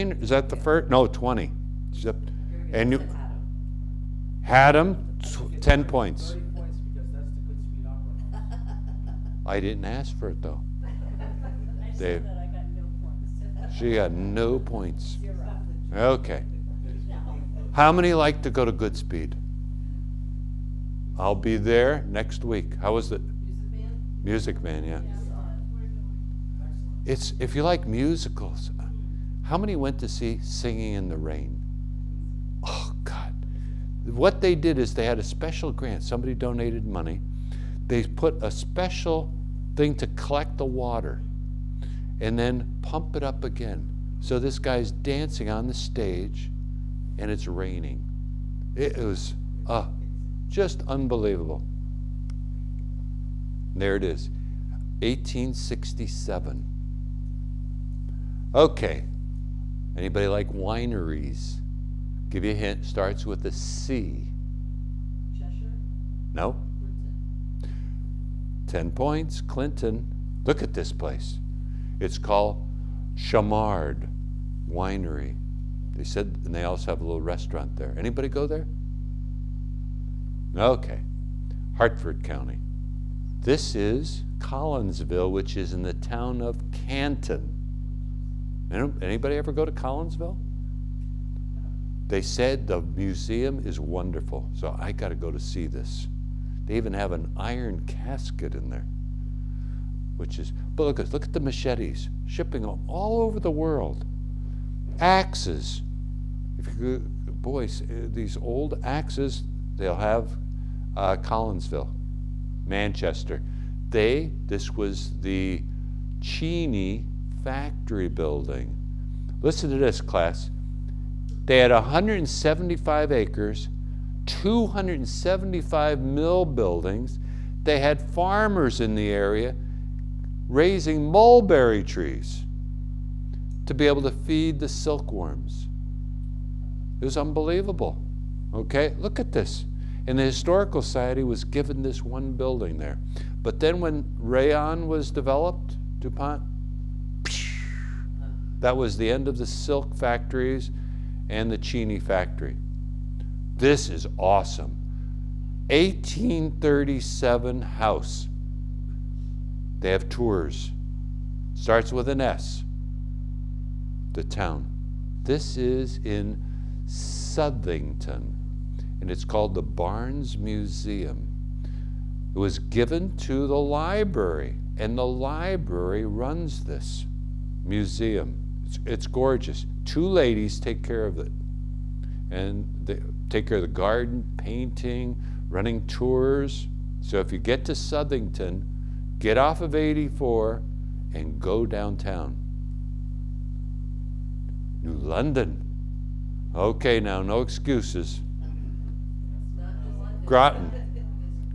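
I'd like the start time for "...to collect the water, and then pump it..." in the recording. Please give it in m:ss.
0:39.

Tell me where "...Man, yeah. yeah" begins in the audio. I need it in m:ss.
0:24.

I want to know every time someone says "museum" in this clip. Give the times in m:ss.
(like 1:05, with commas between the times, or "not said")
1:32, 2:50, 2:57.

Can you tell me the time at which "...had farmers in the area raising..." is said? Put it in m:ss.
2:07.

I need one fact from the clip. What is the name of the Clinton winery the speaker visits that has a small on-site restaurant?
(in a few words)
Chamard Winery.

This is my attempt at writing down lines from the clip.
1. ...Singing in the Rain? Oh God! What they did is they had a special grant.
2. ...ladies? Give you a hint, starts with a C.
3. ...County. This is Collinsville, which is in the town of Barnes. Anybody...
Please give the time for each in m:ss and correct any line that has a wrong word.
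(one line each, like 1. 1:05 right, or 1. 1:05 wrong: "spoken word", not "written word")
1. 0:30 right
2. 1:00 wrong: "wineries", not "ladies"
3. 1:22 wrong: "Canton", not "Barnes".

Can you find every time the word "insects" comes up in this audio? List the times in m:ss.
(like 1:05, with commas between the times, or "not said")
not said.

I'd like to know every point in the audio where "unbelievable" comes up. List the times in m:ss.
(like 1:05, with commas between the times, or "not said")
0:50, 2:17.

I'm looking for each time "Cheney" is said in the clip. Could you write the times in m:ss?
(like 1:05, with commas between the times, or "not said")
1:56, 2:31.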